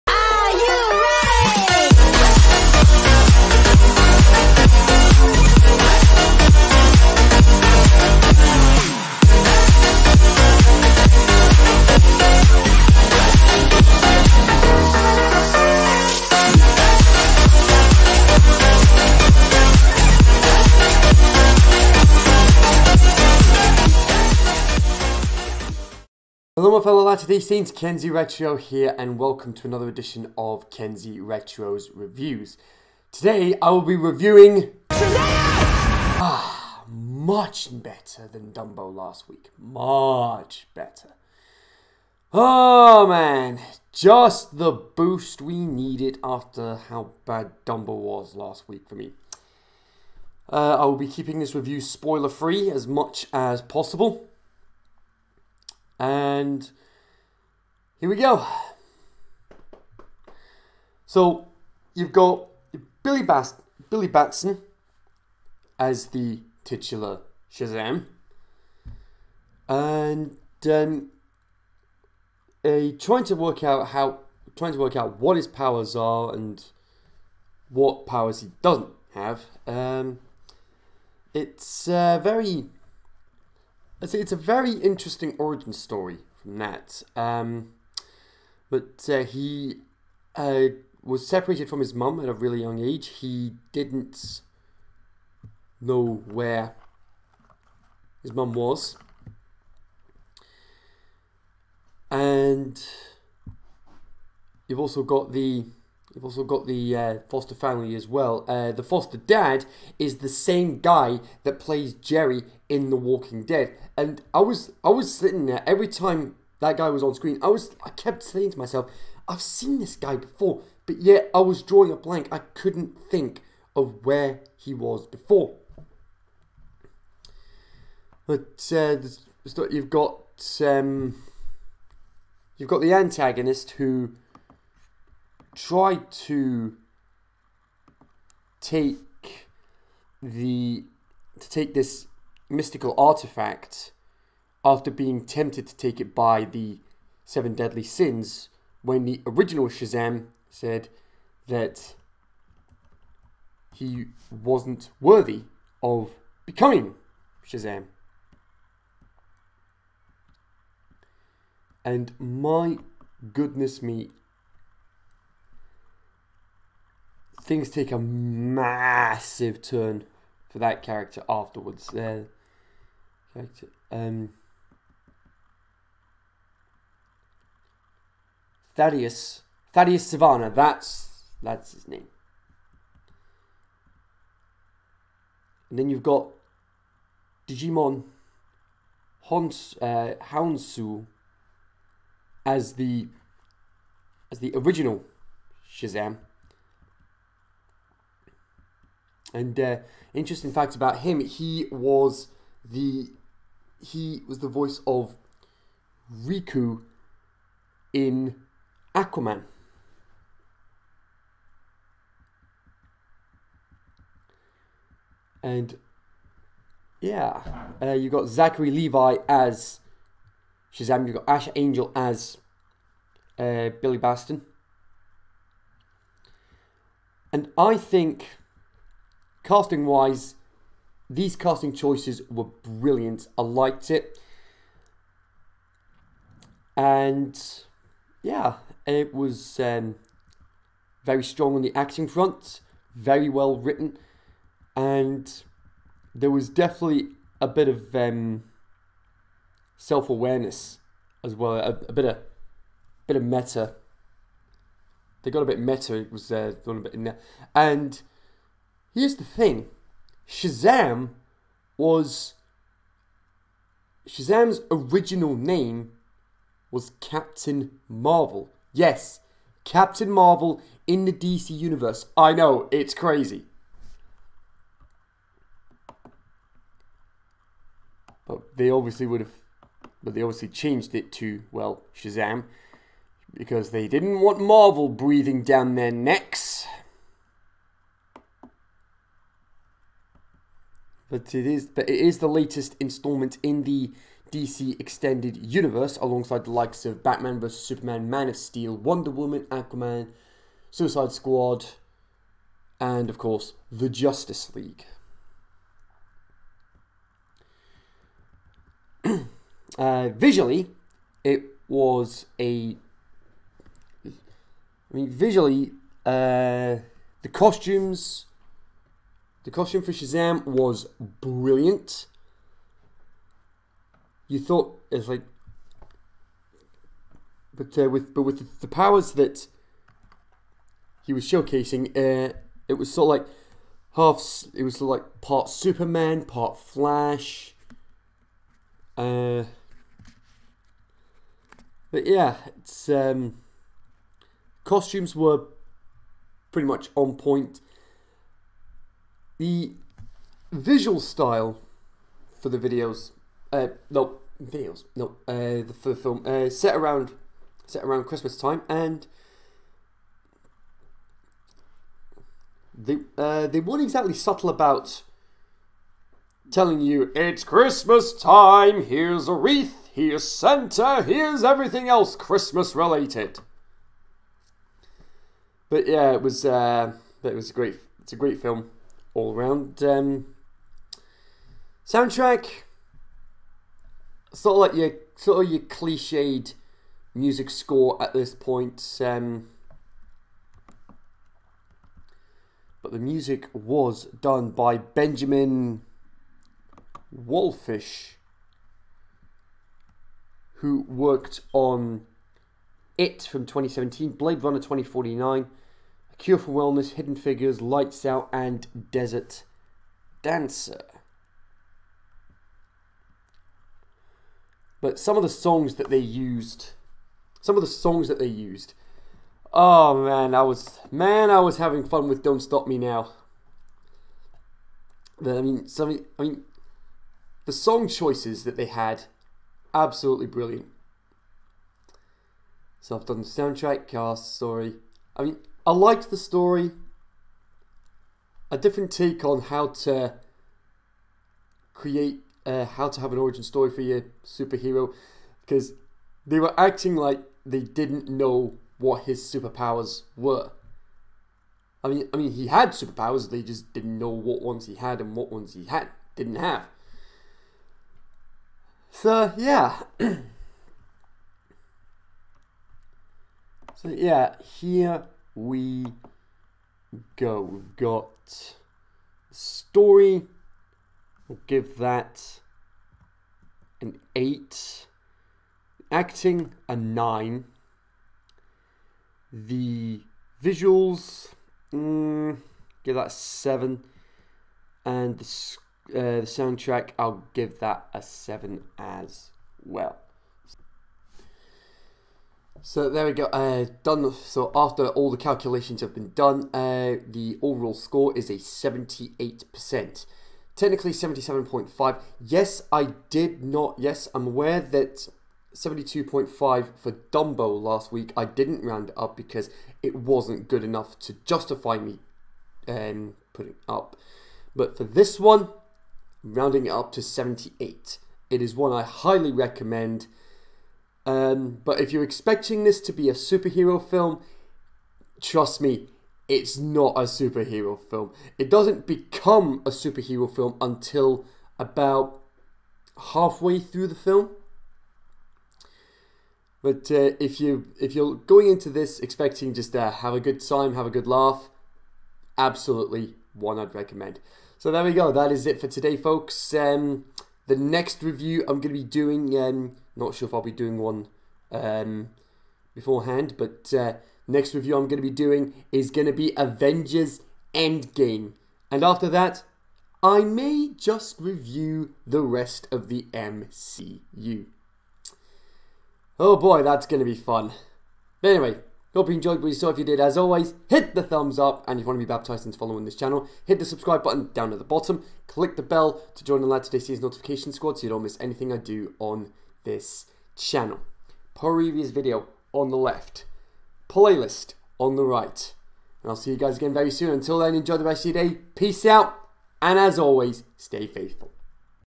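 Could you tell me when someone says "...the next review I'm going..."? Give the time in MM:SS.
09:07.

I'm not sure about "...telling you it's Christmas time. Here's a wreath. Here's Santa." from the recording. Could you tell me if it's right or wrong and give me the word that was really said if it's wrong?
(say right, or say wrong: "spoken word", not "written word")
right.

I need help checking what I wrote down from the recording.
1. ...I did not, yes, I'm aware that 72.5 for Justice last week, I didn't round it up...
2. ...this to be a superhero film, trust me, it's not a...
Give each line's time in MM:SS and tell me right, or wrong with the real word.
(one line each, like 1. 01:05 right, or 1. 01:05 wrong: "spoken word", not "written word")
1. 08:22 wrong: "Dumbo", not "Justice"
2. 08:42 right.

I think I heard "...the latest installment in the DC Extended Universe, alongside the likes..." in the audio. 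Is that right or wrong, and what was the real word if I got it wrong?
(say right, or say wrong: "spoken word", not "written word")
right.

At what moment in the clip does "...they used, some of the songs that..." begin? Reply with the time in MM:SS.
06:55.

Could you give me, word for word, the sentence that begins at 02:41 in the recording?
And my goodness me, things take a massive turn for that character afterwards.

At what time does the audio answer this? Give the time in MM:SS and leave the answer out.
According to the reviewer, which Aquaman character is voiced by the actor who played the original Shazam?
03:26.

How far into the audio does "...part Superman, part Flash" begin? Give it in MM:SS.
05:35.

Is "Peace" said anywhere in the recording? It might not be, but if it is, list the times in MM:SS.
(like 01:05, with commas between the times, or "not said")
09:48.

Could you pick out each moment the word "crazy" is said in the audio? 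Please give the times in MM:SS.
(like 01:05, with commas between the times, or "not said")
04:32.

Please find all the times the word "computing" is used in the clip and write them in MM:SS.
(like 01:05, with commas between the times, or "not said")
not said.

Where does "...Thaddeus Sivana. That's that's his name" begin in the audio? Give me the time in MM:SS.
02:59.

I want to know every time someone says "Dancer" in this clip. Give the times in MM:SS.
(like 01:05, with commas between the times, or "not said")
06:50.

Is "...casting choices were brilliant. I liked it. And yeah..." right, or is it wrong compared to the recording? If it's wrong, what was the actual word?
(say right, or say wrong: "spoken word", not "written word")
right.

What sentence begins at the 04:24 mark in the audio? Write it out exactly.
Shazam's original name was Captain Marvel.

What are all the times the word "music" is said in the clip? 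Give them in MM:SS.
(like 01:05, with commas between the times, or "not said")
06:27, 06:32.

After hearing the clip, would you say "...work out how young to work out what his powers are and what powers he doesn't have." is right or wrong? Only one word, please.
wrong.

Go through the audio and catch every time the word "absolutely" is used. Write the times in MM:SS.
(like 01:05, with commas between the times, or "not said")
07:09, 09:02.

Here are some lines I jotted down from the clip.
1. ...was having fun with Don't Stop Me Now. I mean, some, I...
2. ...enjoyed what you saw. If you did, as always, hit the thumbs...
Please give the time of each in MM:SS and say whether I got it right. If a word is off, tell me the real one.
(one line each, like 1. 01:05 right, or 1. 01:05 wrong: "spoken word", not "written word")
1. 07:01 right
2. 09:29 right.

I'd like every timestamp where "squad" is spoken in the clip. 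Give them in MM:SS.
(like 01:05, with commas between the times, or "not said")
05:01, 09:37.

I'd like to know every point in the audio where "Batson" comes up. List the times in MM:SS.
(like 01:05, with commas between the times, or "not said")
01:04, 03:43.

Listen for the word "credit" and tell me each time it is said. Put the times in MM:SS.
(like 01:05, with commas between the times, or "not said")
not said.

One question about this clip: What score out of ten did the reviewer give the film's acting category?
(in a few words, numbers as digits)
9.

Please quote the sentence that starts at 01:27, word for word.
Um, but uh, he uh, was separated from his mum at a really young age.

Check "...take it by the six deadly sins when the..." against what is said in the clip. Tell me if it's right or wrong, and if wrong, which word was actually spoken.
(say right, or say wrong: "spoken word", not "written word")
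wrong: "seven", not "six".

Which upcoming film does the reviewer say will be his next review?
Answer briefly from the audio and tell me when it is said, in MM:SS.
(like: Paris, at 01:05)
Avengers Endgame, at 09:16.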